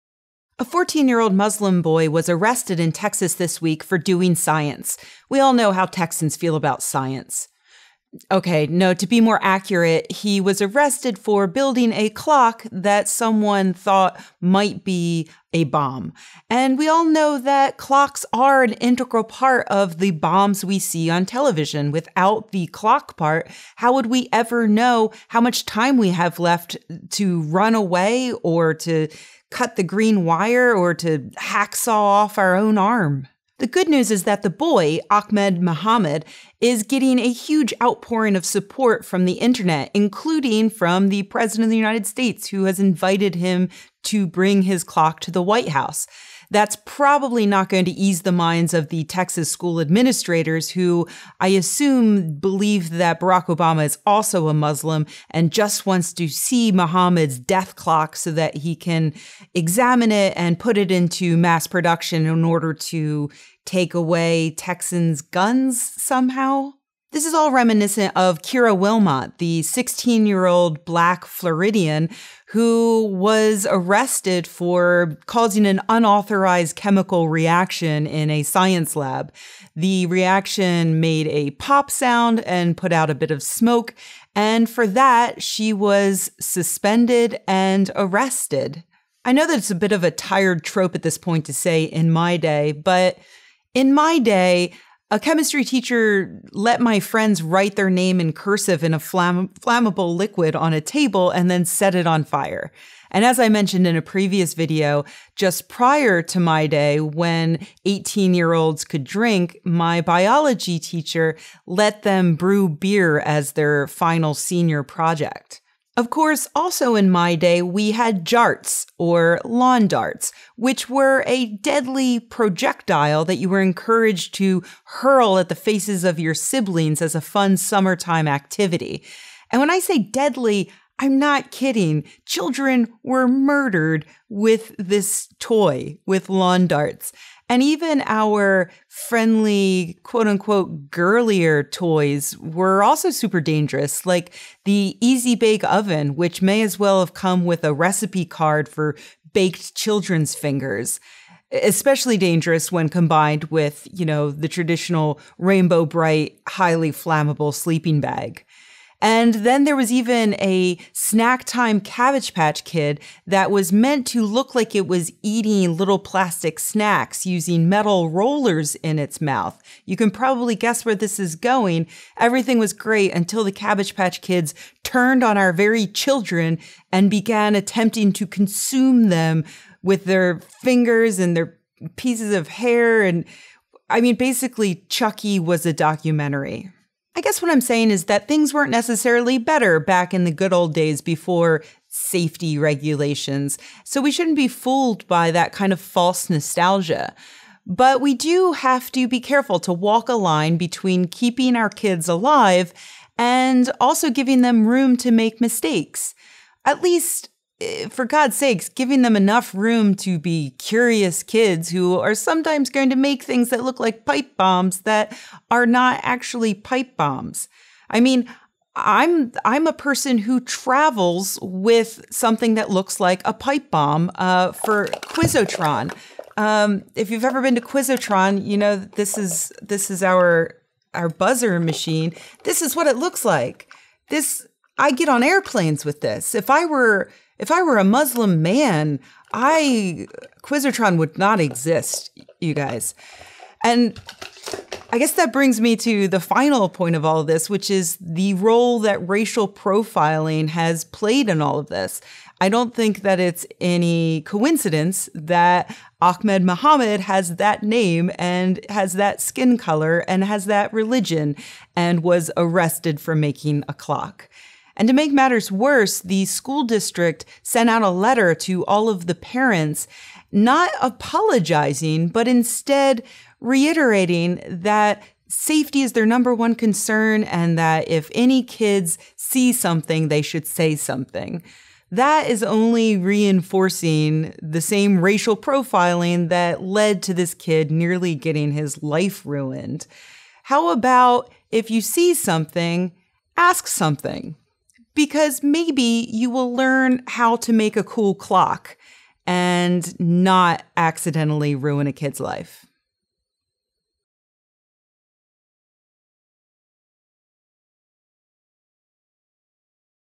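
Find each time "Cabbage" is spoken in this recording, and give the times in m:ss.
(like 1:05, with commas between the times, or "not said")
2:41, 2:53.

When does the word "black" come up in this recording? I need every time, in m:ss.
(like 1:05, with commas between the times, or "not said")
1:10.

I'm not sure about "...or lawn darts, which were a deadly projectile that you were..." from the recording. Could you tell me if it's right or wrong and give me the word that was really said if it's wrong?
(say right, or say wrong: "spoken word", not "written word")
right.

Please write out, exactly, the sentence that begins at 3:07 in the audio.
I guess what I'm saying is that things weren't necessarily better back in the good old days before safety regulations.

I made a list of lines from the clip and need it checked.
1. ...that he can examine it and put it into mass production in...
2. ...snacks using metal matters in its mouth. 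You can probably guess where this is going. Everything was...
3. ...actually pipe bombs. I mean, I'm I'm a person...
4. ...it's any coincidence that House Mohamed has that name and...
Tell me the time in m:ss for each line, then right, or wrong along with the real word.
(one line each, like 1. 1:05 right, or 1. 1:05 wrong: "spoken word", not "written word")
1. 0:58 right
2. 2:46 wrong: "rollers", not "matters"
3. 3:36 right
4. 4:13 wrong: "Ahmed", not "House".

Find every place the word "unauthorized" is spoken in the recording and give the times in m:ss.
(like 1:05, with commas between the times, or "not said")
1:15.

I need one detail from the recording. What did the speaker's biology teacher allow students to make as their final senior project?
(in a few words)
beer.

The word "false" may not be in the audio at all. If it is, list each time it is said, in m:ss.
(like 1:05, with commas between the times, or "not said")
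3:15.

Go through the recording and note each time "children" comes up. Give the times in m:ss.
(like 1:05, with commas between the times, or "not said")
2:12, 2:29, 2:55.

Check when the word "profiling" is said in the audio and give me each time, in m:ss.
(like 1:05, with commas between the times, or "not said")
4:09, 4:45.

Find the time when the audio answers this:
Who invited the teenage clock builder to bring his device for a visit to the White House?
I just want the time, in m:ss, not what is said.
0:41.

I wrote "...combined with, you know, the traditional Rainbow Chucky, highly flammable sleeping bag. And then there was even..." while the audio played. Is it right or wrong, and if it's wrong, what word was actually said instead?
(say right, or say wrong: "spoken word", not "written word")
wrong: "Brite", not "Chucky".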